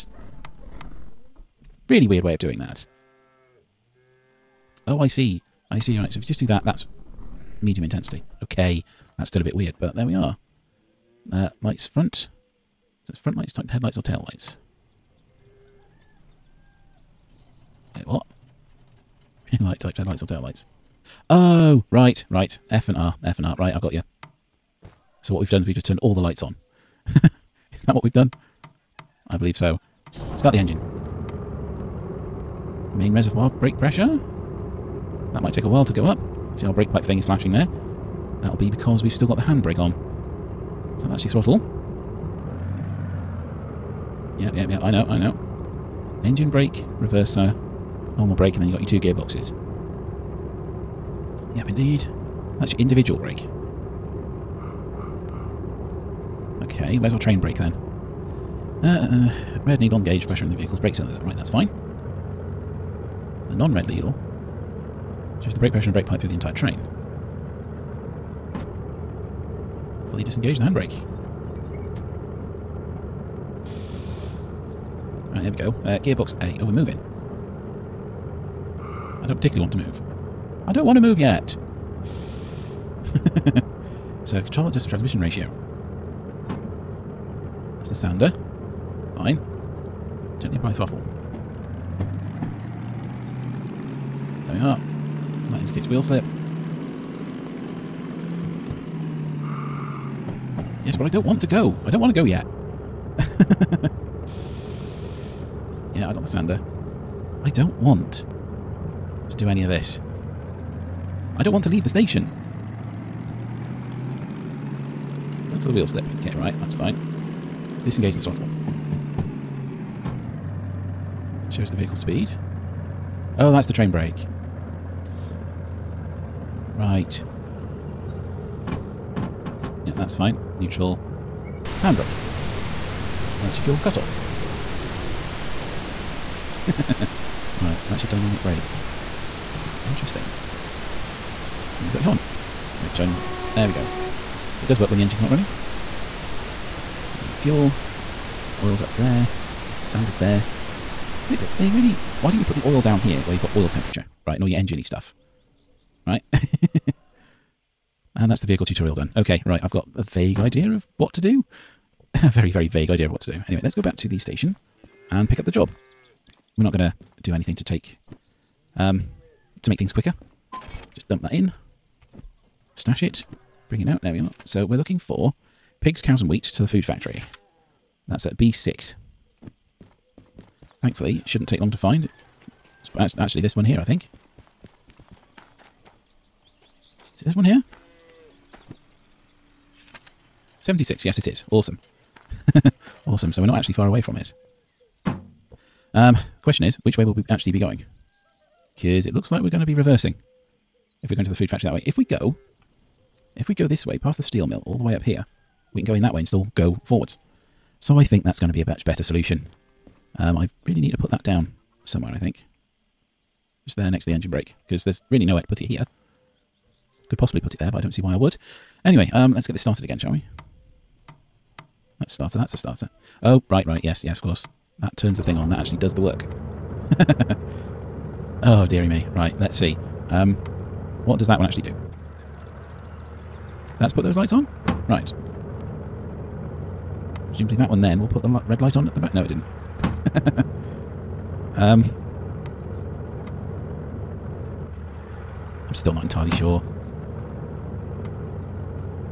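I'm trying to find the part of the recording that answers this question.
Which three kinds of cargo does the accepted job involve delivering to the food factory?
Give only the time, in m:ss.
2:55.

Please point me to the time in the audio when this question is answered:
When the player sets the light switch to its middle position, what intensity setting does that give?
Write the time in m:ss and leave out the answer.
0:07.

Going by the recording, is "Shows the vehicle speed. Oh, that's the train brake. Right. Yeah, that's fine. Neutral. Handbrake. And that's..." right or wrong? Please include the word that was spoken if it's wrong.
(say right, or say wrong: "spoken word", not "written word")
right.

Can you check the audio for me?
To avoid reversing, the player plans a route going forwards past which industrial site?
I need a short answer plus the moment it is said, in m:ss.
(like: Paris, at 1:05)
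The steel mill, at 3:24.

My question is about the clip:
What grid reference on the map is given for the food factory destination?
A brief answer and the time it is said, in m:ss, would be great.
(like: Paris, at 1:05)
B6, at 2:58.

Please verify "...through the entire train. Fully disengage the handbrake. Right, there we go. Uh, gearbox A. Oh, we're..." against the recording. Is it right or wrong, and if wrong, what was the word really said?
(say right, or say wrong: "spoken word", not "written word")
right.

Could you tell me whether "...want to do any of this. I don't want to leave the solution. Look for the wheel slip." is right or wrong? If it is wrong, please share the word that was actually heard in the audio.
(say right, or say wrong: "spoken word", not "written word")
wrong: "station", not "solution".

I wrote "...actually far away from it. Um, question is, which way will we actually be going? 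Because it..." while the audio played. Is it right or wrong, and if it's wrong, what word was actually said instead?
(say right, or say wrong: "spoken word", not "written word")
right.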